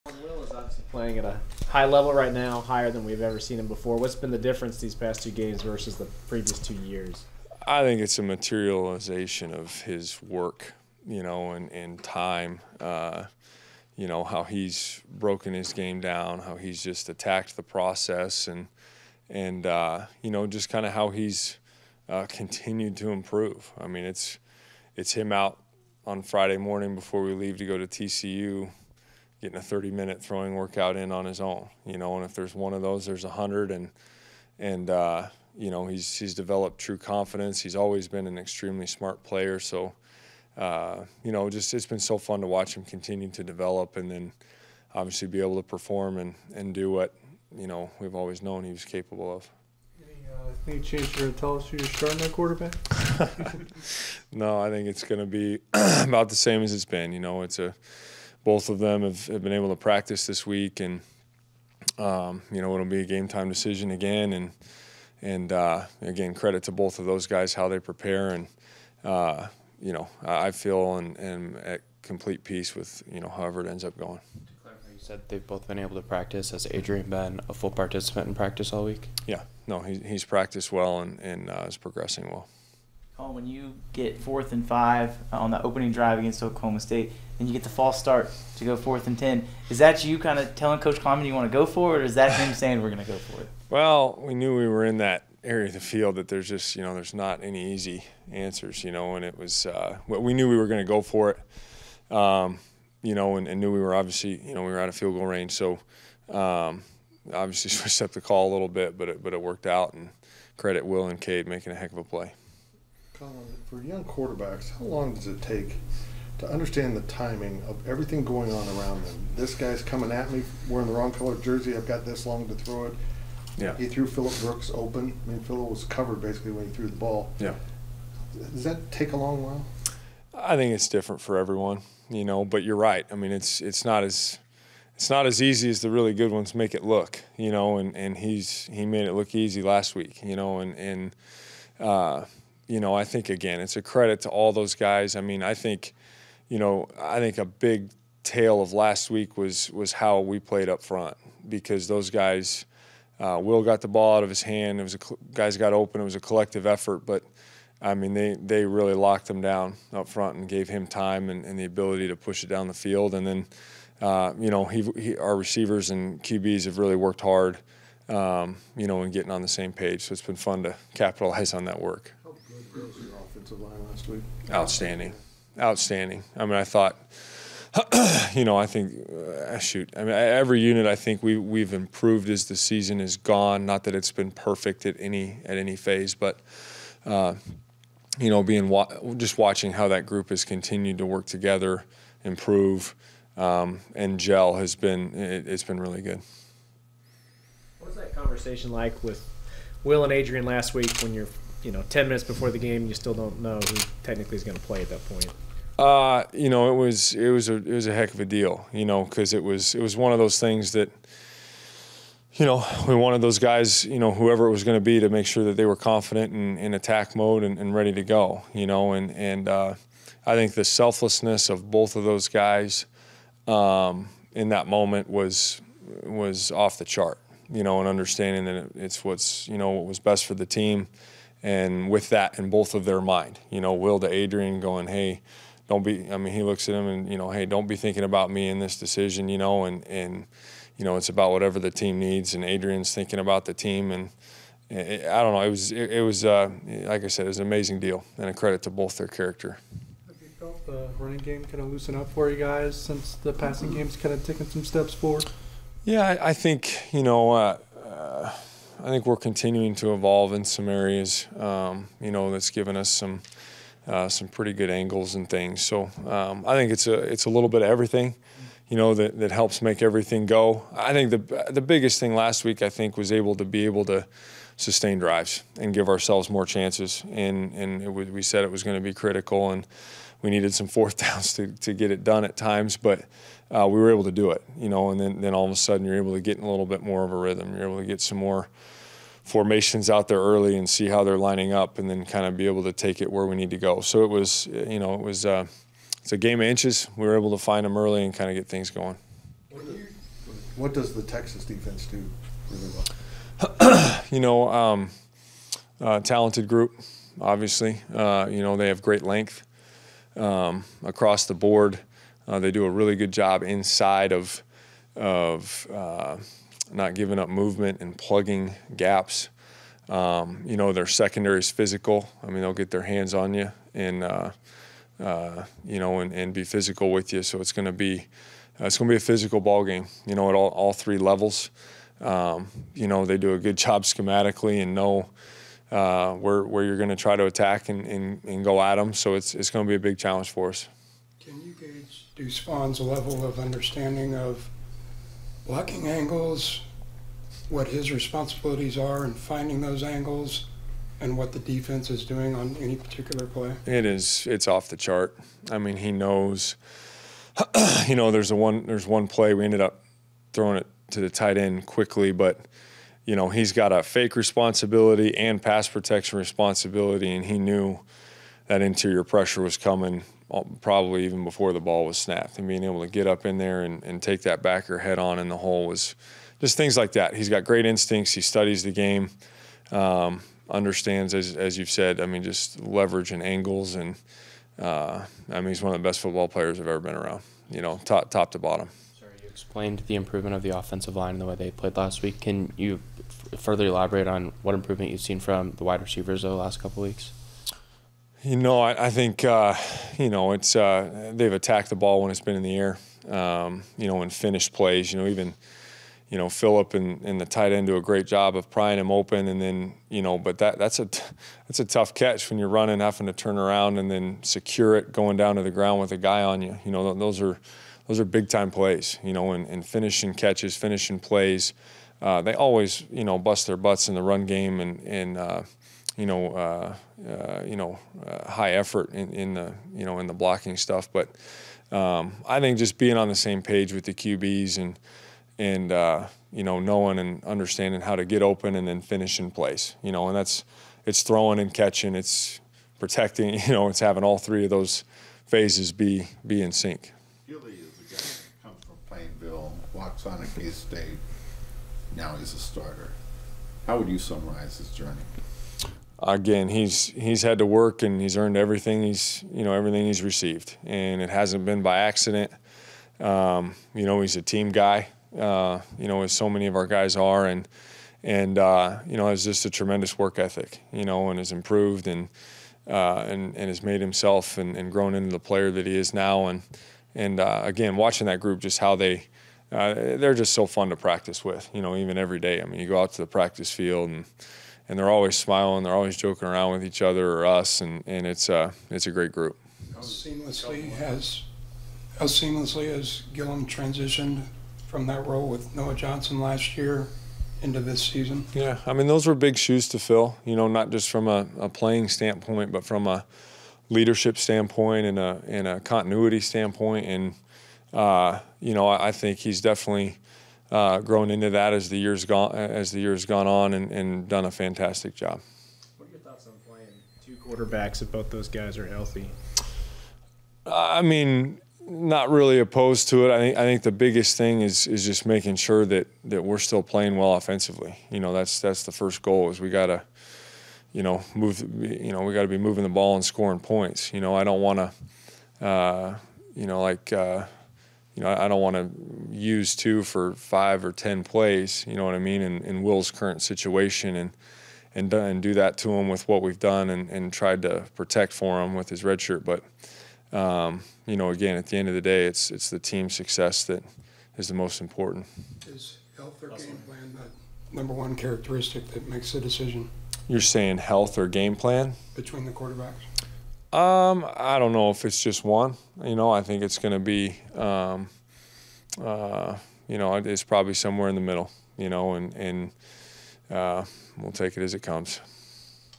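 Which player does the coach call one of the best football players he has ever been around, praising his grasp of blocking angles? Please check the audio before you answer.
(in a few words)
Spawn.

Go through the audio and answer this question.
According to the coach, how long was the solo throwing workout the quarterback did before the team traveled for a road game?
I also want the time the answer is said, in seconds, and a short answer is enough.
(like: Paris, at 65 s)
30 minutes, at 29 s.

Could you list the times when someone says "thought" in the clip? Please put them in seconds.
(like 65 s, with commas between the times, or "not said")
176 s, 516 s.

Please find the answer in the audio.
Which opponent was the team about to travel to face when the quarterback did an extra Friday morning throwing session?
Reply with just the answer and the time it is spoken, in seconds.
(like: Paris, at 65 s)
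TCU, at 27 s.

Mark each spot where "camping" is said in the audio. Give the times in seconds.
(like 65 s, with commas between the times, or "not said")
not said.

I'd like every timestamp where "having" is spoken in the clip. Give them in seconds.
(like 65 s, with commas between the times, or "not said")
412 s, 443 s.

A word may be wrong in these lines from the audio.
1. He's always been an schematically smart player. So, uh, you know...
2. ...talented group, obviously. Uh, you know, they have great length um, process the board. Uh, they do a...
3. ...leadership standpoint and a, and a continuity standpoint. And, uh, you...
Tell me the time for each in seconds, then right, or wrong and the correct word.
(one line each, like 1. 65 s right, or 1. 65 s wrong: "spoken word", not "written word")
1. 37 s wrong: "extremely", not "schematically"
2. 305 s wrong: "across", not "process"
3. 503 s right.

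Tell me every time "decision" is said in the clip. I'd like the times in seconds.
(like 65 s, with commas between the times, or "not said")
63 s, 238 s, 559 s.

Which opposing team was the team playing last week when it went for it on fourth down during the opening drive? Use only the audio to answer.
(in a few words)
Oklahoma State.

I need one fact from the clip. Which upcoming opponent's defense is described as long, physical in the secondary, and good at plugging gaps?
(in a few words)
Texas.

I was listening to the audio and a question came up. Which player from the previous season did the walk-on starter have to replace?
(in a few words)
Noah Johnson.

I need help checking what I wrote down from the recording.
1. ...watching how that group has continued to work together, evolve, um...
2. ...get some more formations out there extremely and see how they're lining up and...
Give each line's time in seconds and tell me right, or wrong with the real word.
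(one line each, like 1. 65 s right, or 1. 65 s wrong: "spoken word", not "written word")
1. 189 s wrong: "improve", not "evolve"
2. 287 s wrong: "early", not "extremely".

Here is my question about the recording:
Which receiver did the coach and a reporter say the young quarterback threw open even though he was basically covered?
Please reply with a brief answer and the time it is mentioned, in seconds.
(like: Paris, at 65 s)
Phillip Brooks, at 124 s.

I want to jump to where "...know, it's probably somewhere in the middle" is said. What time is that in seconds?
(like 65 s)
569 s.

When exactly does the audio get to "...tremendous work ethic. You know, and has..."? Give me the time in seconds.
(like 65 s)
469 s.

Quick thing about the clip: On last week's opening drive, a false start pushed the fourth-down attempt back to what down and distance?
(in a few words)
fourth and ten.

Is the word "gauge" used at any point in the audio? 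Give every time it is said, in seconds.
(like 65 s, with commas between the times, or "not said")
341 s.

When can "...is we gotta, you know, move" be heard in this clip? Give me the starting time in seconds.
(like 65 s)
529 s.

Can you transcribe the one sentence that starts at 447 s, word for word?
Gilly walks on at K State.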